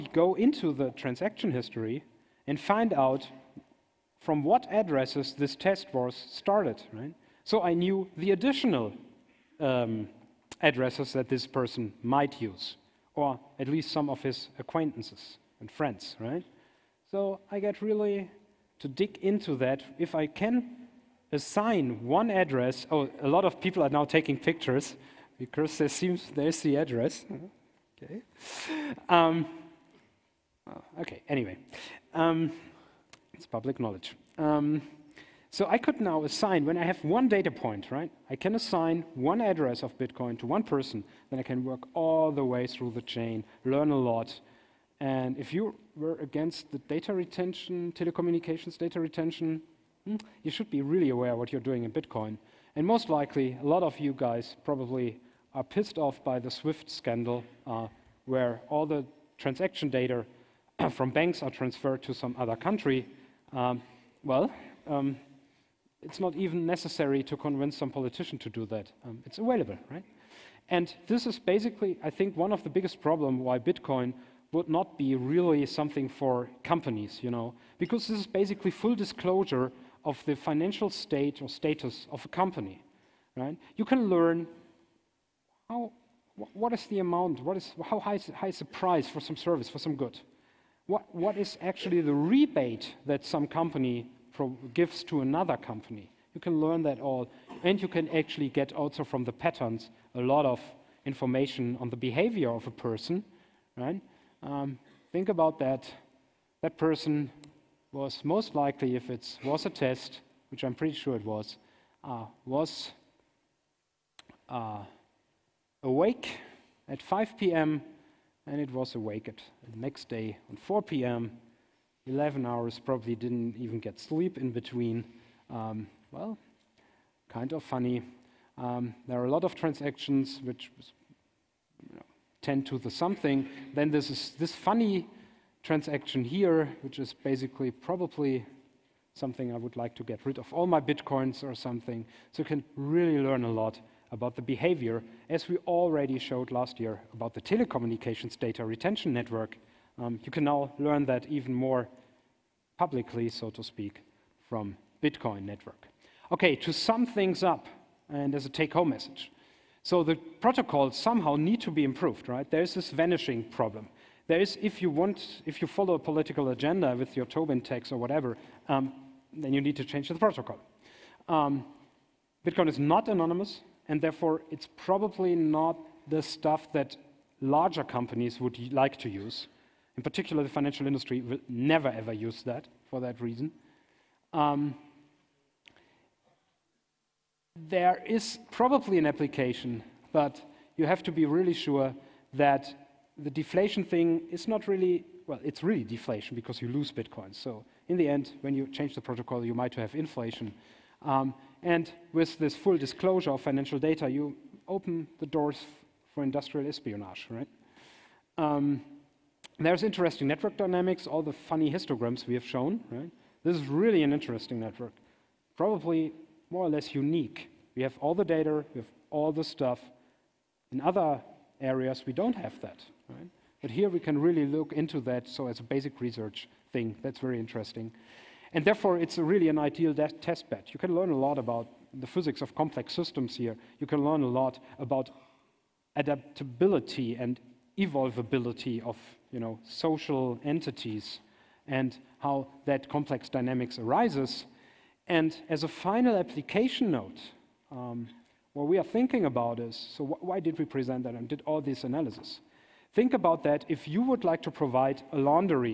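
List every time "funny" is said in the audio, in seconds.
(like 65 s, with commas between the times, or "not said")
127 s, 134 s, 211 s.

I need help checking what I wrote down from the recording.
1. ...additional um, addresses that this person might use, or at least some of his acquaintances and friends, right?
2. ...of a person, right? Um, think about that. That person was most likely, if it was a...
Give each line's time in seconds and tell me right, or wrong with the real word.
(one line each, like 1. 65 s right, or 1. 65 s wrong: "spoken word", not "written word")
1. 8 s right
2. 102 s right.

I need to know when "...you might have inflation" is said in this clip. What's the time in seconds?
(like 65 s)
199 s.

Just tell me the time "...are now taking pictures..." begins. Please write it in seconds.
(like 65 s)
23 s.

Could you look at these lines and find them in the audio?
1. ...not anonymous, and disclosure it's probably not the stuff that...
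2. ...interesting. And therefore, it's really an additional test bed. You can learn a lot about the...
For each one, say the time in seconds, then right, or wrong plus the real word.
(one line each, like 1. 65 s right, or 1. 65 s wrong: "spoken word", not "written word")
1. 172 s wrong: "therefore", not "disclosure"
2. 227 s wrong: "ideal", not "additional".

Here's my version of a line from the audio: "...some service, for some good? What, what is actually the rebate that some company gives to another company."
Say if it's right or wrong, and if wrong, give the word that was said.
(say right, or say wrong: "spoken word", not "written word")
right.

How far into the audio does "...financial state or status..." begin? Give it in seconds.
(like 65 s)
80 s.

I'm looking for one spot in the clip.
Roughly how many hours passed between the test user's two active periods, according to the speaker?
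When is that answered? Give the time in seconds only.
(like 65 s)
122 s.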